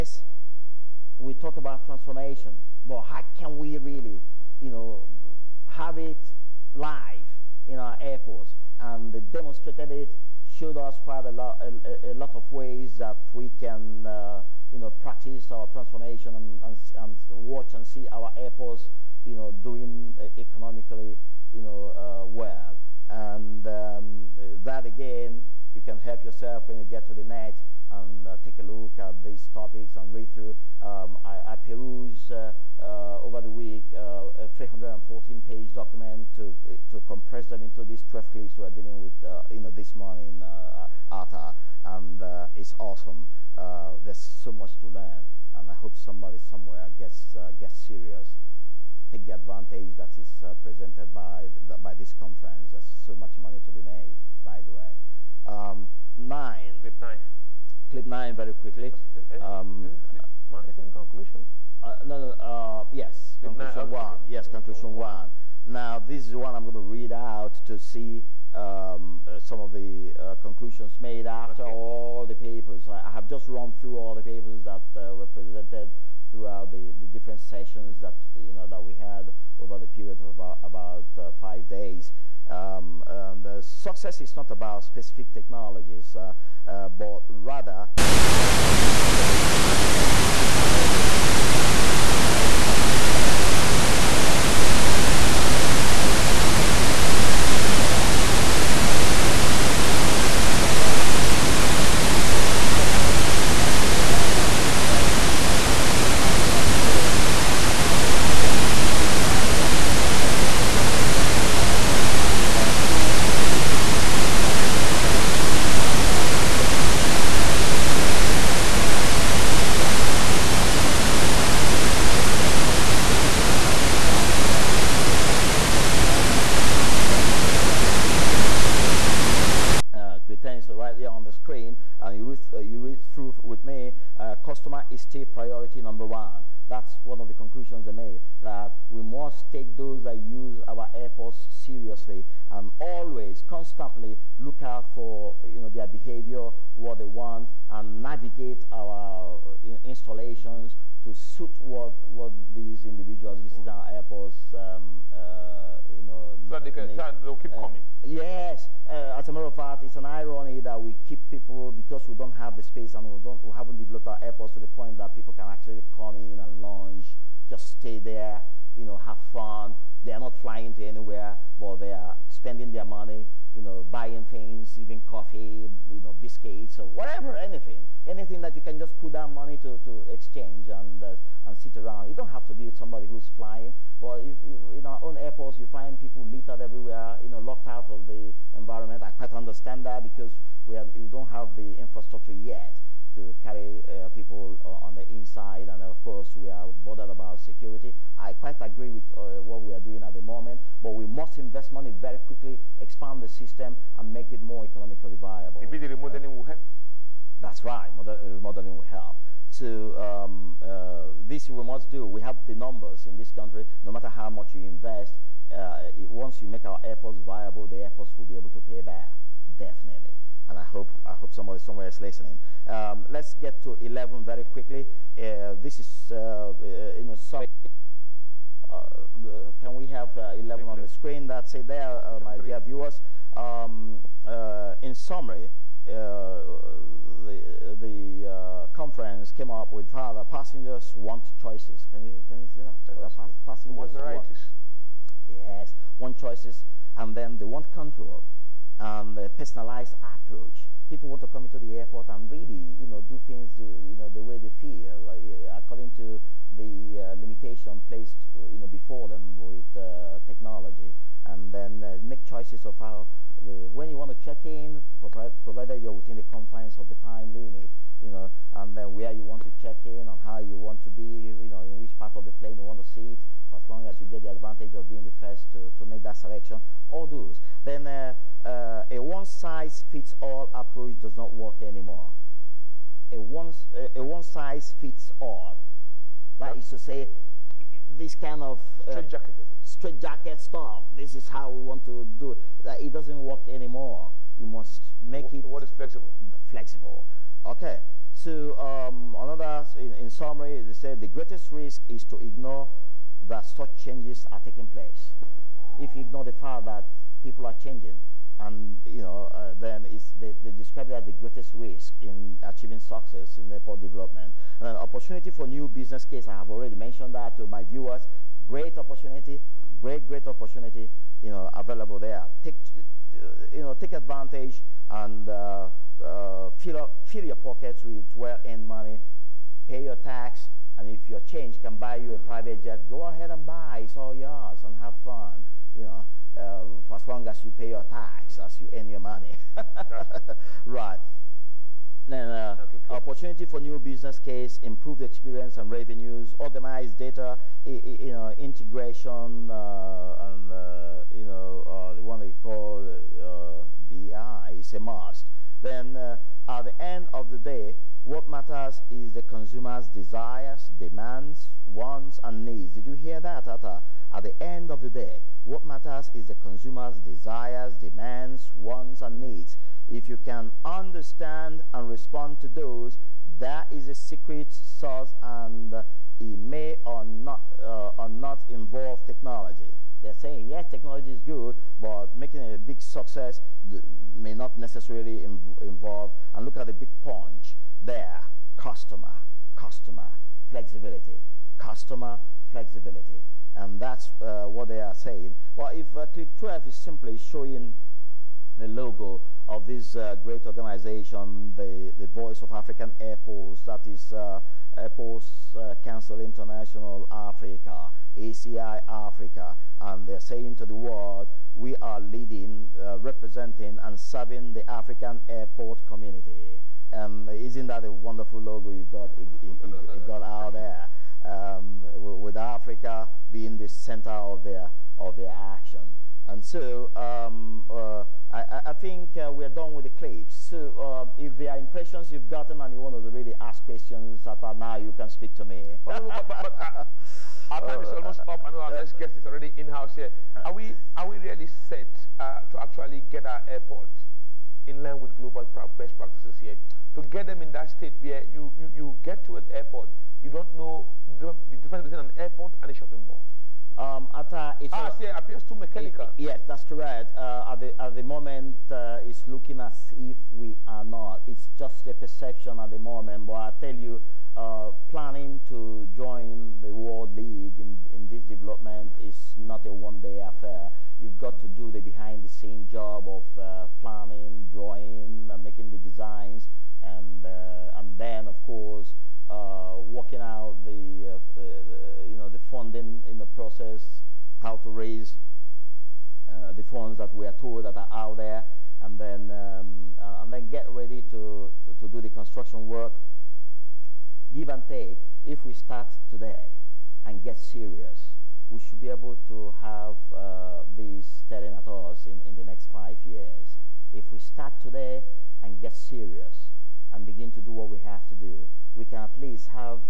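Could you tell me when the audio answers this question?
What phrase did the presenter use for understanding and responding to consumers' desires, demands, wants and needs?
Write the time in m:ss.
6:13.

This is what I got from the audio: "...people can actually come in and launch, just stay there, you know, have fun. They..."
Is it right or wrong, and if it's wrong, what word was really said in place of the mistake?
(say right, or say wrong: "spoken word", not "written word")
right.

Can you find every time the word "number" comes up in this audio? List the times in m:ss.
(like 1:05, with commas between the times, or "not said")
2:15, 3:32.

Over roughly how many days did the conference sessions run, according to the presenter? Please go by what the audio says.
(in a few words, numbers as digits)
5.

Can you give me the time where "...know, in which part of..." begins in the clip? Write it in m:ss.
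4:31.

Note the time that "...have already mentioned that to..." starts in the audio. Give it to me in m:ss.
5:16.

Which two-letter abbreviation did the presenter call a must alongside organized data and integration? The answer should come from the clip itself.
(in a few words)
BI.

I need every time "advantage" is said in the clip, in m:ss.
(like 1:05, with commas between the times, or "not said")
0:49, 4:34, 5:23.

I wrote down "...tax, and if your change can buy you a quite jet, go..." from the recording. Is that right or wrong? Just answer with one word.
wrong.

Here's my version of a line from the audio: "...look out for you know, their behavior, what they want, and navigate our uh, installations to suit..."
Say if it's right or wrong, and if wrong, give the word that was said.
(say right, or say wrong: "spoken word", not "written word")
right.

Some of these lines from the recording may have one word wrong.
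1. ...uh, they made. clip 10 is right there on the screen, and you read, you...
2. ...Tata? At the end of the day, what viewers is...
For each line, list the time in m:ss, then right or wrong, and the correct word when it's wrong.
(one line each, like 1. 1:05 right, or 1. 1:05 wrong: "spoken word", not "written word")
1. 2:07 right
2. 6:03 wrong: "matters", not "viewers".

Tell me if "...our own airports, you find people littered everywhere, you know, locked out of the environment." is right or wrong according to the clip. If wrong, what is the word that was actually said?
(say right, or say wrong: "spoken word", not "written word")
right.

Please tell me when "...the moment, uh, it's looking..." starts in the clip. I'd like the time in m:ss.
7:37.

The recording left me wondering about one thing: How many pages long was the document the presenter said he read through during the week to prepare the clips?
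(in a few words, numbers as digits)
314.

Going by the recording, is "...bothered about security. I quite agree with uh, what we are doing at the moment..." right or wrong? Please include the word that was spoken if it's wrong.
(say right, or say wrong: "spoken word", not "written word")
right.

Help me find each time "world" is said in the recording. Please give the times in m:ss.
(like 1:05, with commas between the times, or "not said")
6:50, 7:46.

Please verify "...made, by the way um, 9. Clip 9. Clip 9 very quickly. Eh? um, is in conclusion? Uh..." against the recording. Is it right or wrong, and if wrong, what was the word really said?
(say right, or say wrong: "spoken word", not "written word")
right.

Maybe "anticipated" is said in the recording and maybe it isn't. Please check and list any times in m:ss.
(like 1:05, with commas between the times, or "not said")
not said.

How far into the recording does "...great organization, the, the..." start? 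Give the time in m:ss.
6:40.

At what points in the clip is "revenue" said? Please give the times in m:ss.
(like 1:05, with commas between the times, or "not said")
2:02, 5:45.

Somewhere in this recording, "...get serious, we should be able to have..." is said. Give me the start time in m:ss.
8:17.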